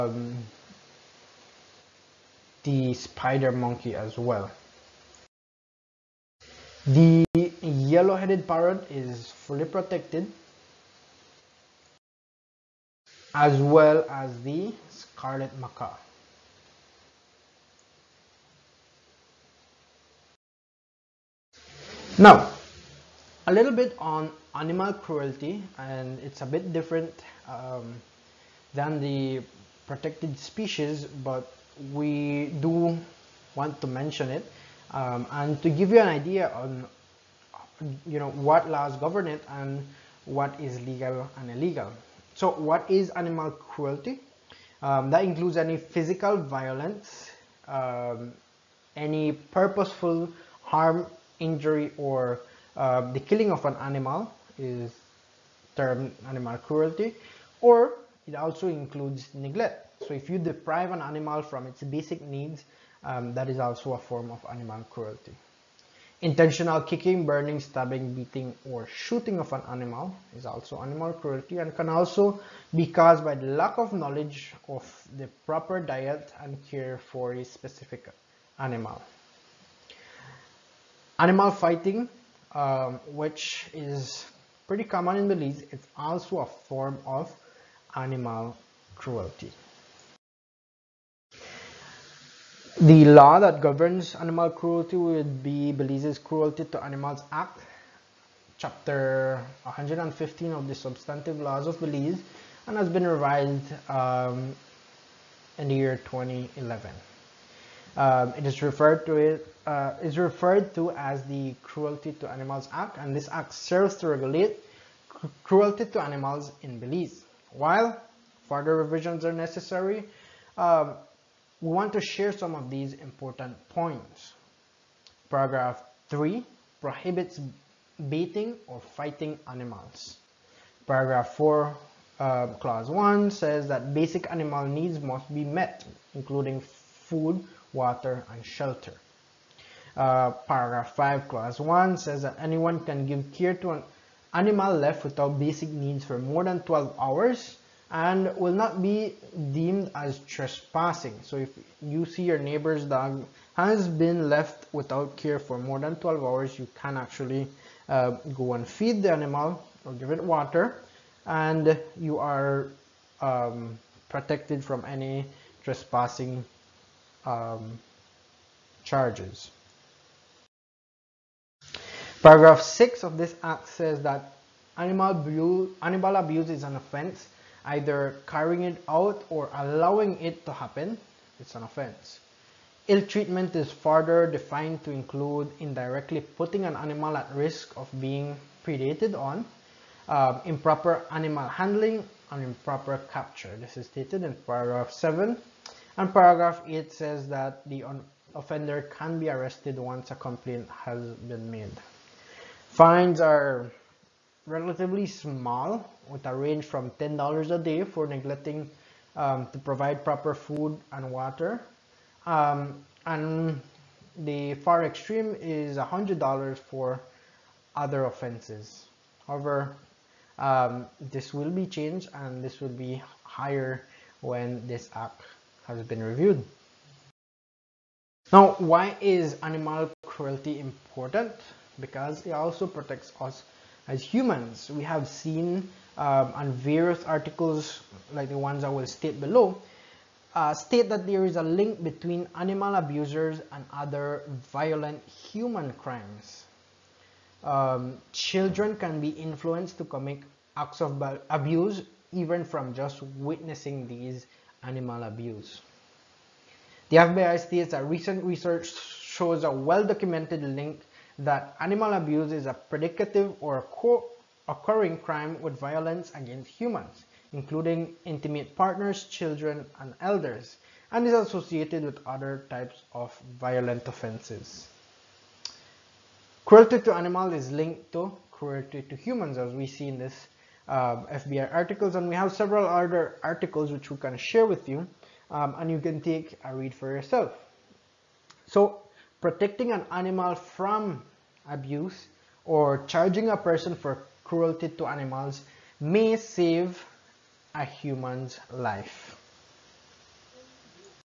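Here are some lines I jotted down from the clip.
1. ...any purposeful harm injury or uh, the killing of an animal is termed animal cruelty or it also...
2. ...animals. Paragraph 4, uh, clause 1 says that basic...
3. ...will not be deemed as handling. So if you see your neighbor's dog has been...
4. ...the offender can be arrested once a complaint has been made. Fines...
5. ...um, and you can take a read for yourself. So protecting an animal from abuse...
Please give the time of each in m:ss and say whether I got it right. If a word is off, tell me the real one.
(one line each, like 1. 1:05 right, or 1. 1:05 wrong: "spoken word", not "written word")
1. 0:48 right
2. 2:09 right
3. 2:28 wrong: "trespassing", not "handling"
4. 3:17 right
5. 4:45 right.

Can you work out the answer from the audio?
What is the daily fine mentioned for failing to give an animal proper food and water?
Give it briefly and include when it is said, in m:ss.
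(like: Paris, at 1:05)
$10 a day, at 3:26.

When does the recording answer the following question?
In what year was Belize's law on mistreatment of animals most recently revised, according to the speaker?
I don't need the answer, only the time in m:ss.
1:46.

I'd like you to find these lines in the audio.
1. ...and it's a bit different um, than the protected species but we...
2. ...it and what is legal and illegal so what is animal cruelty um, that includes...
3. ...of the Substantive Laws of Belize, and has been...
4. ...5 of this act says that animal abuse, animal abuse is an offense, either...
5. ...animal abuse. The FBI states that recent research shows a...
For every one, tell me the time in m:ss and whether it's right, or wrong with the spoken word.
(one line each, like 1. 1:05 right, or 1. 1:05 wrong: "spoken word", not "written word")
1. 0:25 right
2. 0:39 right
3. 1:40 right
4. 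2:52 wrong: "6", not "5"
5. 4:14 right.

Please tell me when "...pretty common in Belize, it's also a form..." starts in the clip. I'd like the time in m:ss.
1:24.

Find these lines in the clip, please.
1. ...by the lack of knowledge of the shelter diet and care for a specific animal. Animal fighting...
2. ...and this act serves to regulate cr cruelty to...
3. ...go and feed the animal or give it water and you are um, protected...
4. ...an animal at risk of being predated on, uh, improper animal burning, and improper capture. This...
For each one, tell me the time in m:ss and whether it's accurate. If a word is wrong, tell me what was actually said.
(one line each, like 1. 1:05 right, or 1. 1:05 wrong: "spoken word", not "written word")
1. 1:13 wrong: "proper", not "shelter"
2. 1:52 right
3. 2:38 right
4. 3:06 wrong: "handling", not "burning".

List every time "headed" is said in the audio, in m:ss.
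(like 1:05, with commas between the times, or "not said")
0:07.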